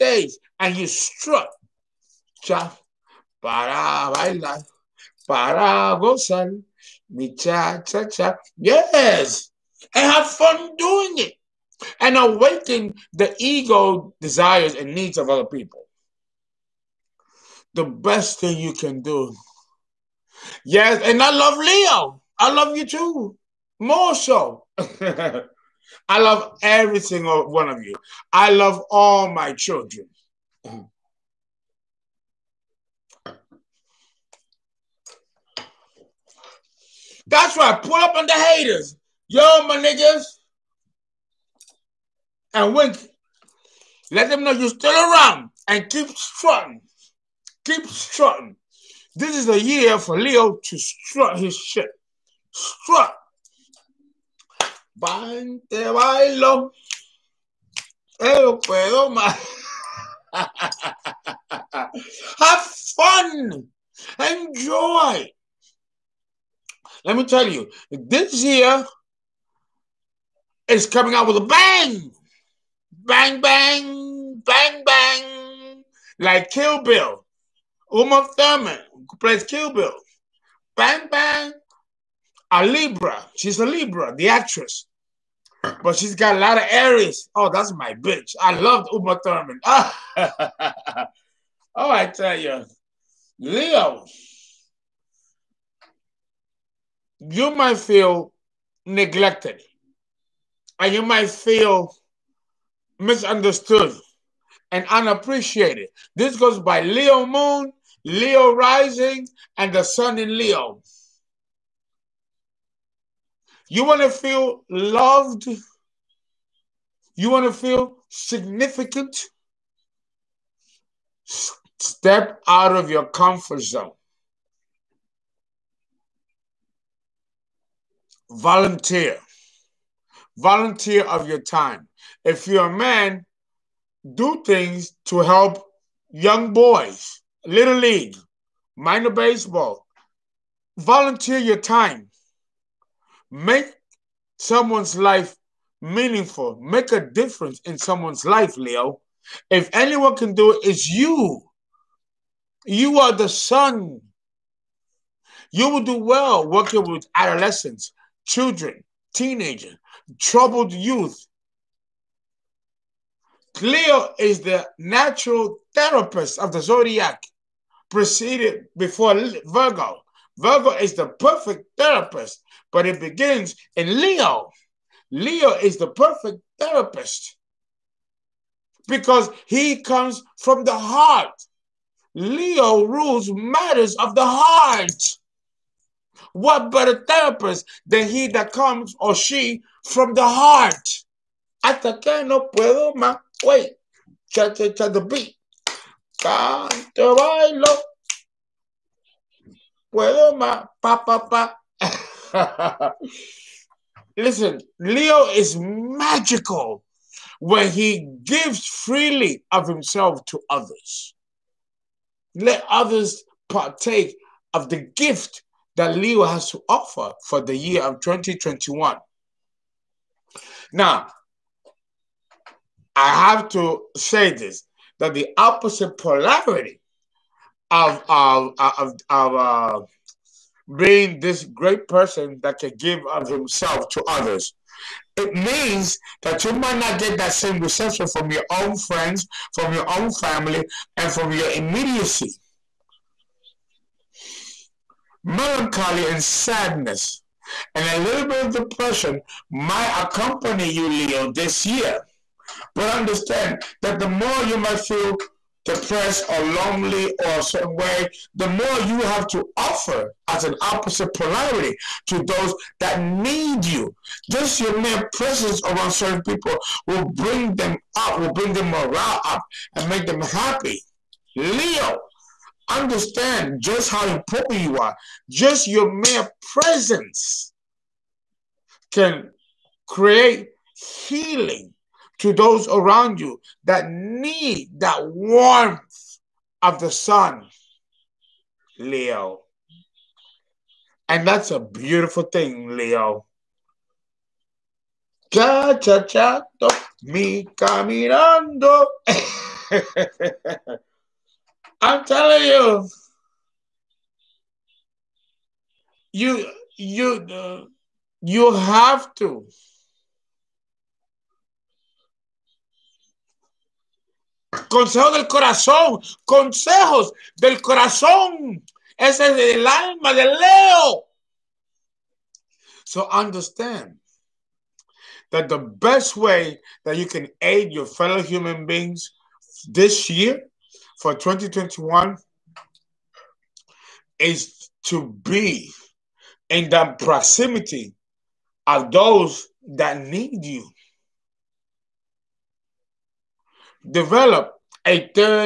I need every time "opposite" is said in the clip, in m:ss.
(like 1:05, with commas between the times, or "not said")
3:45, 4:20.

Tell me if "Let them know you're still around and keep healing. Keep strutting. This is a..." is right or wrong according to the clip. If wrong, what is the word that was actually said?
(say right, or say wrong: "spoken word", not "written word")
wrong: "strutting", not "healing".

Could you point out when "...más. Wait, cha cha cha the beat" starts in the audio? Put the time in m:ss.
3:12.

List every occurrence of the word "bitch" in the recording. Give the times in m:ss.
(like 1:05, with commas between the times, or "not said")
1:27.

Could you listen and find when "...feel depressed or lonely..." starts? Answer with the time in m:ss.
4:14.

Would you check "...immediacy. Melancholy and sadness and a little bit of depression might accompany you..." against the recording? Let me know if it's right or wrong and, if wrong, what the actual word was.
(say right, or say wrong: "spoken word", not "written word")
right.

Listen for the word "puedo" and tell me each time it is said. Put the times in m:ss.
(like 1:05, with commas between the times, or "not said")
0:58, 3:12, 3:19.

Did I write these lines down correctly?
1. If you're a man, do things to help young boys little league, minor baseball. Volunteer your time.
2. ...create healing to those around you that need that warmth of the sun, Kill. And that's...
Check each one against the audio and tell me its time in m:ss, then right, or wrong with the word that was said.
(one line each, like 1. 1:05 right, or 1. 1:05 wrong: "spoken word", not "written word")
1. 2:12 right
2. 4:39 wrong: "Leo", not "Kill".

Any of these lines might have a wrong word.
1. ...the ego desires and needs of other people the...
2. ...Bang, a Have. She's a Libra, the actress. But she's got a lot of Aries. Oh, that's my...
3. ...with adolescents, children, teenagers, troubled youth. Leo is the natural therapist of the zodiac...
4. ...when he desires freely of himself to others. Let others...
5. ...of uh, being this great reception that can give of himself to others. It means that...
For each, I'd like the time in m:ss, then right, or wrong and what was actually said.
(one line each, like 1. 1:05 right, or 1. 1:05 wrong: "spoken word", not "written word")
1. 0:13 right
2. 1:21 wrong: "Libra", not "Have"
3. 2:36 right
4. 3:27 wrong: "gives", not "desires"
5. 3:49 wrong: "person", not "reception".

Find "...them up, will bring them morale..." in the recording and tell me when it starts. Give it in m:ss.
4:27.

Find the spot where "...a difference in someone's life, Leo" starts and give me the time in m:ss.
2:26.